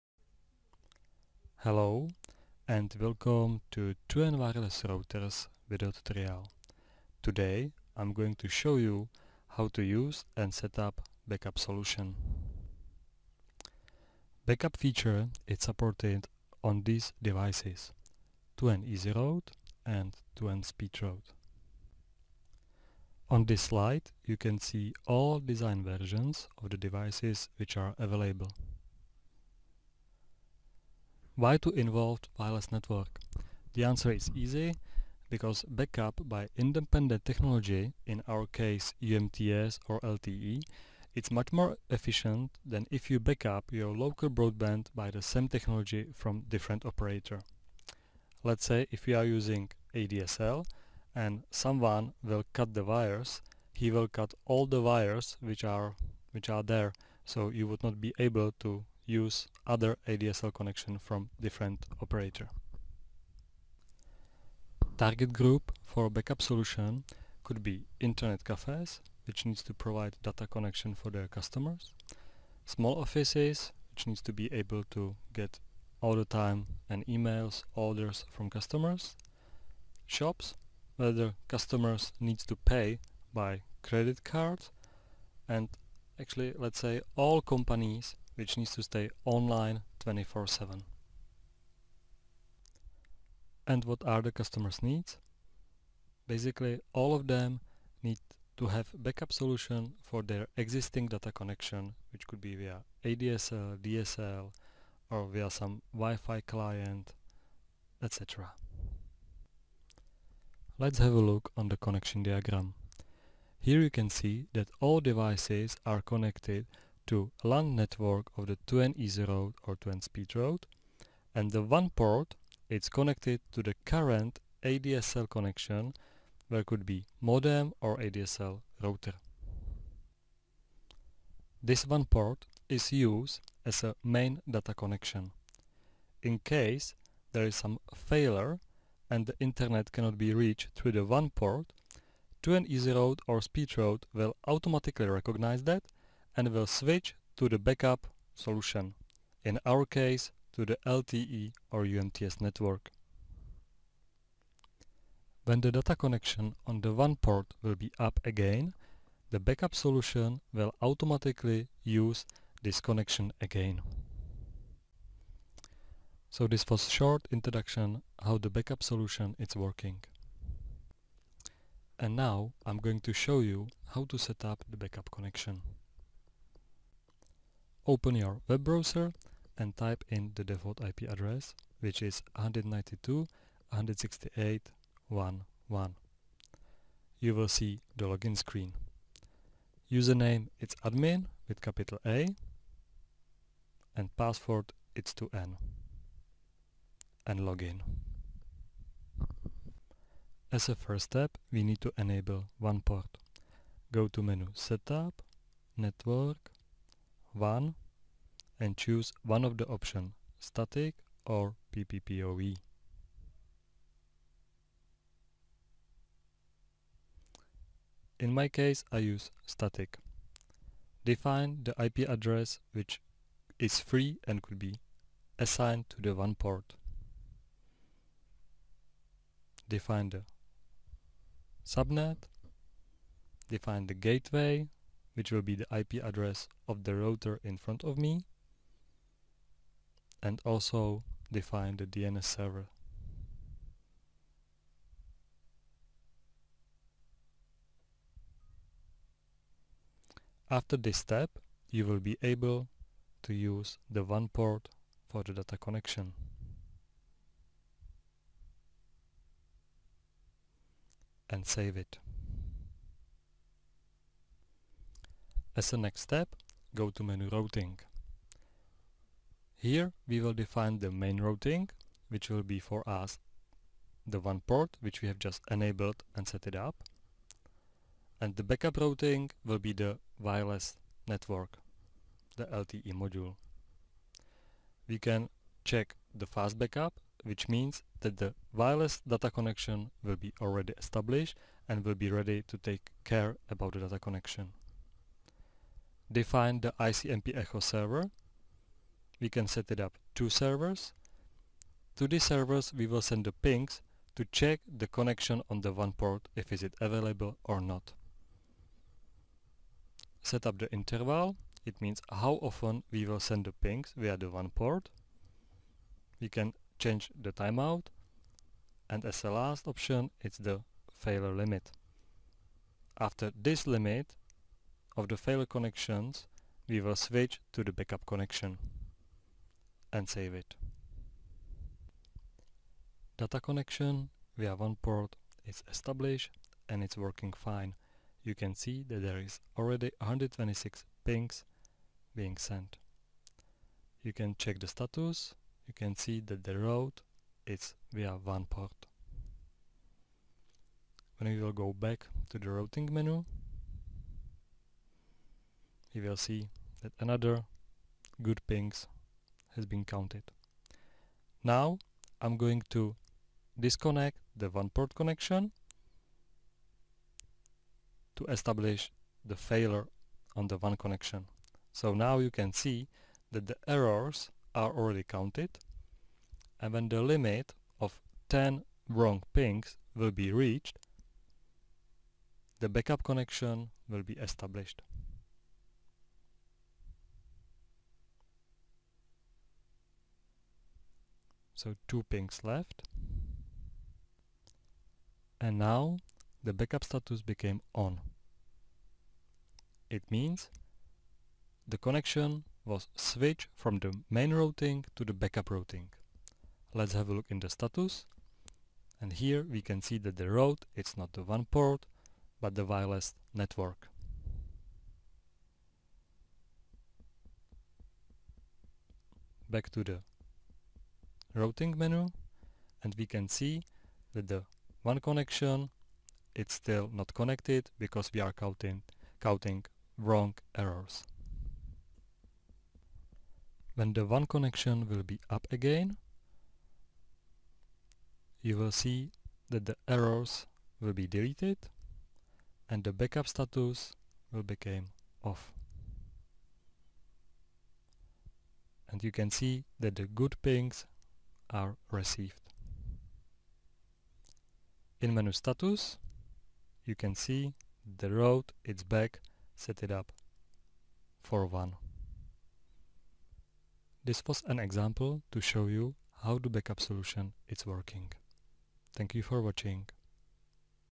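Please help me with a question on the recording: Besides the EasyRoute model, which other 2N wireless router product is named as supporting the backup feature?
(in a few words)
2N SpeedRoute.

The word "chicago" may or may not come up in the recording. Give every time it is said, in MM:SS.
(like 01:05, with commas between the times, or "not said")
not said.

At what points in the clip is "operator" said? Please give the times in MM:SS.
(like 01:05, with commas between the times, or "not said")
00:46, 01:02.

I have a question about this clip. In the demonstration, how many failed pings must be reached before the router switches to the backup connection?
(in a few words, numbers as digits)
10.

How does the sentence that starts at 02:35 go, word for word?
When the data connection on the WAN port will be up again, the backup solution will automatically use this connection again.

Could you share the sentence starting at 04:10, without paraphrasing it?
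After this step, you will be able to use the WAN port for the data connection.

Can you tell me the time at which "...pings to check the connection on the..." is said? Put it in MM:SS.
05:03.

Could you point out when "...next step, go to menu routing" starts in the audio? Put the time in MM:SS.
04:25.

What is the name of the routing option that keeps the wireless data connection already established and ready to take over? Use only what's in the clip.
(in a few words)
Fast backup.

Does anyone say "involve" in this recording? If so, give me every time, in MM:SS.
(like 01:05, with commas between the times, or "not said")
00:31.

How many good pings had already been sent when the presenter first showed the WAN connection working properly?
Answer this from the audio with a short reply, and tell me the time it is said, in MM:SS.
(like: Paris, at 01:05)
126, at 05:39.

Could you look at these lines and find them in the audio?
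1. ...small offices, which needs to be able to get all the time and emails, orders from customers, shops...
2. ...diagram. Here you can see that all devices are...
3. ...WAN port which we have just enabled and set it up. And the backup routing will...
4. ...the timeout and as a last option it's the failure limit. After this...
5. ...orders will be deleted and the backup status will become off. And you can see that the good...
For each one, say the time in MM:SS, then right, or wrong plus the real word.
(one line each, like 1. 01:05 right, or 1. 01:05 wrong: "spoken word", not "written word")
1. 01:12 right
2. 01:52 right
3. 04:34 right
4. 05:17 right
5. 07:19 wrong: "errors", not "orders".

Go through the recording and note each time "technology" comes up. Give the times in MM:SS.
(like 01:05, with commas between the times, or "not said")
00:37, 00:45.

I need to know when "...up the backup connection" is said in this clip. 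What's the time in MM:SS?
02:54.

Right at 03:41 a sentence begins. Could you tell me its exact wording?
Define the IP address which is free and could be assigned to the WAN port.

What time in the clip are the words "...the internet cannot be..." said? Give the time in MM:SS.
02:19.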